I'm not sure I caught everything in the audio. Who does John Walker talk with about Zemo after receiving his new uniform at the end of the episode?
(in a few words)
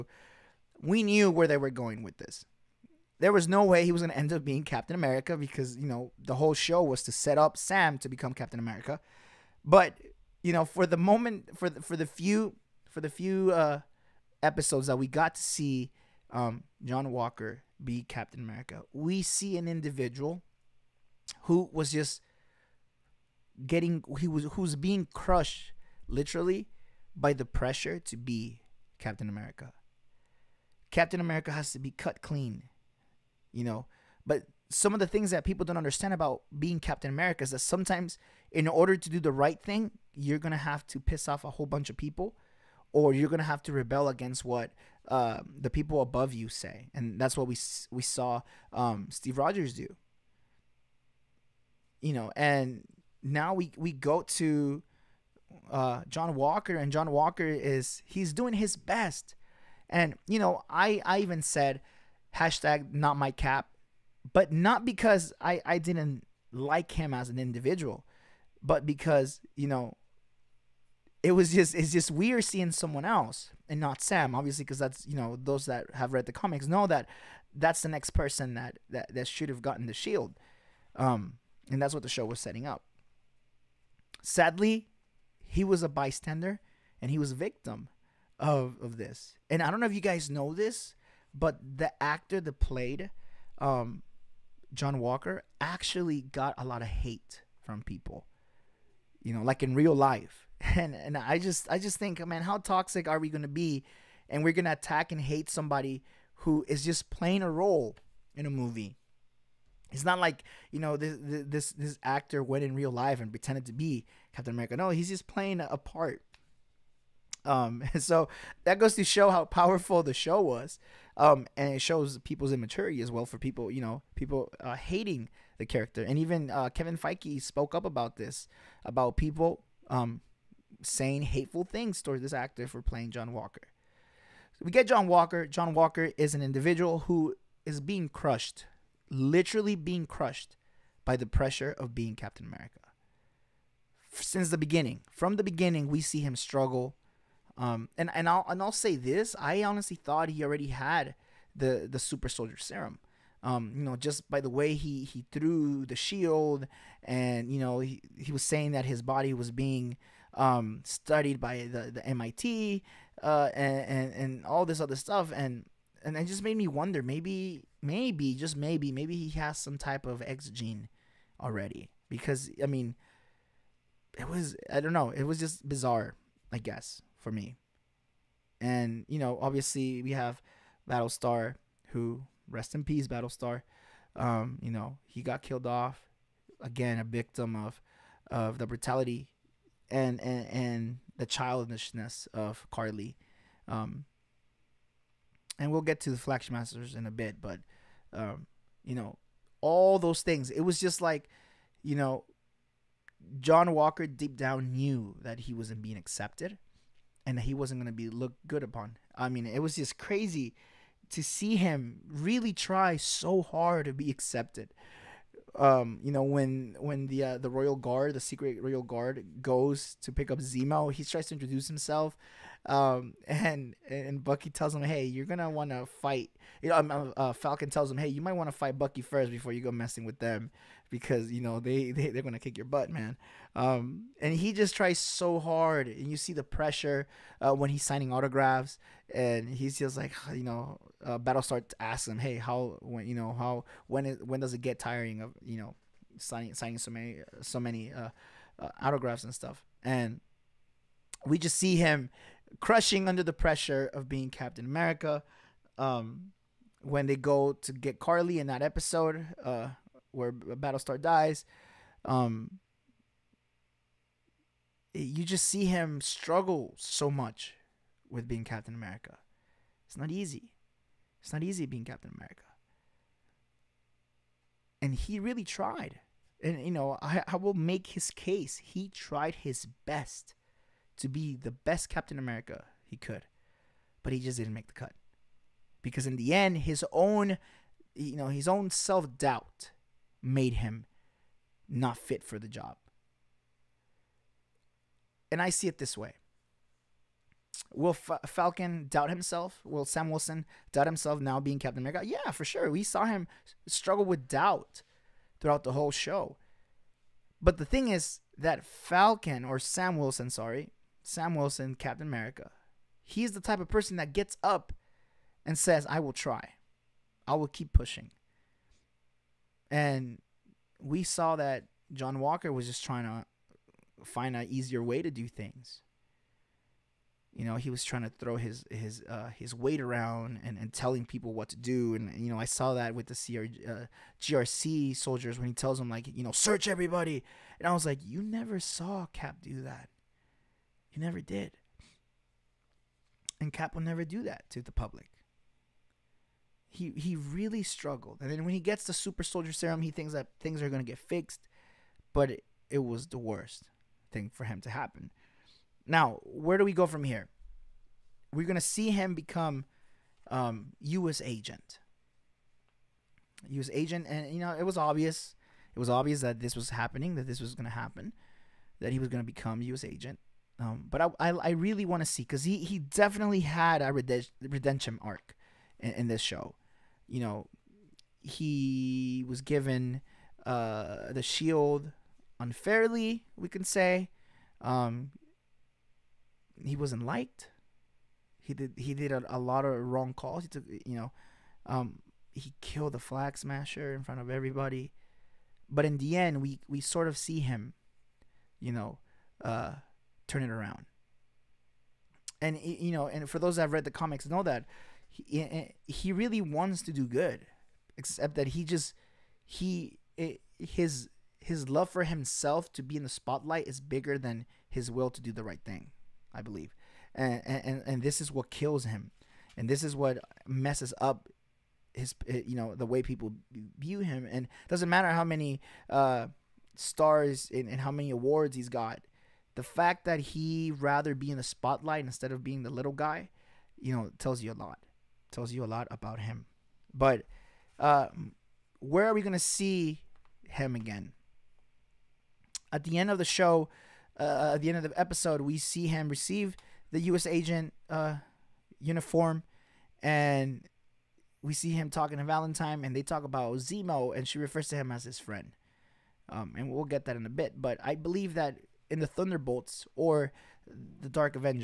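Valentine.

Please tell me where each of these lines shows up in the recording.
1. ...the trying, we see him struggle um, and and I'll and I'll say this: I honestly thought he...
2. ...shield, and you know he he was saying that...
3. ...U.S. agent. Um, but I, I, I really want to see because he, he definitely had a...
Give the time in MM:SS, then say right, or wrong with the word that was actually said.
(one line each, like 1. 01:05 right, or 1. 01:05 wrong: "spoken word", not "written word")
1. 02:25 wrong: "beginning", not "trying"
2. 02:35 right
3. 06:09 right.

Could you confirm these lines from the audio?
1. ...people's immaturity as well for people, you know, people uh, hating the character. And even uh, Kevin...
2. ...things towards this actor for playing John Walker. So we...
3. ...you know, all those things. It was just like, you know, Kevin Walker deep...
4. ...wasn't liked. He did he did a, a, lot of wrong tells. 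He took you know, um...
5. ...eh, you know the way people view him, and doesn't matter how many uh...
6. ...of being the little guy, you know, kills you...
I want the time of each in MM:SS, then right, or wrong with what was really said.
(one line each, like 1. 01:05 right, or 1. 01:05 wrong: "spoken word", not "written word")
1. 02:02 right
2. 02:11 right
3. 03:18 wrong: "John", not "Kevin"
4. 06:26 wrong: "calls", not "tells"
5. 07:02 right
6. 07:12 wrong: "tells", not "kills".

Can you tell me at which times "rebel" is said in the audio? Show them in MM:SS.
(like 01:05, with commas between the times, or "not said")
00:43.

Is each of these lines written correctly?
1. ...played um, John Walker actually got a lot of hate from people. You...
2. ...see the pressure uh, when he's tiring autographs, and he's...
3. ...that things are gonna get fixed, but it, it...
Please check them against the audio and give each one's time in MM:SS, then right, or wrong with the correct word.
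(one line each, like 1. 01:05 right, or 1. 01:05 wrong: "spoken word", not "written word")
1. 01:32 right
2. 03:56 wrong: "signing", not "tiring"
3. 05:50 right.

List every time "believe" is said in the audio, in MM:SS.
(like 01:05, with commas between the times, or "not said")
06:56, 07:37.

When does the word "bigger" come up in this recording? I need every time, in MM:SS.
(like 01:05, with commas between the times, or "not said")
06:53.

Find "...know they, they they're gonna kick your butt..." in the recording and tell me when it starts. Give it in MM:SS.
03:51.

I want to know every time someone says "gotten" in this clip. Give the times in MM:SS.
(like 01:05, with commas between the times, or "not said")
01:19.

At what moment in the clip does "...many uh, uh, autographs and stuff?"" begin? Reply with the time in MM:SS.
04:07.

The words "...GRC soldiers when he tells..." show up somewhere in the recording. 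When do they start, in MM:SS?
05:34.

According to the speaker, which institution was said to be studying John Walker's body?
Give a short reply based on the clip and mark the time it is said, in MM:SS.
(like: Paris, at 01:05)
MIT, at 02:41.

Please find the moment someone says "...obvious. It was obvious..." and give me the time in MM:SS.
06:04.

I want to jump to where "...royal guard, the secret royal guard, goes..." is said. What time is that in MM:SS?
03:37.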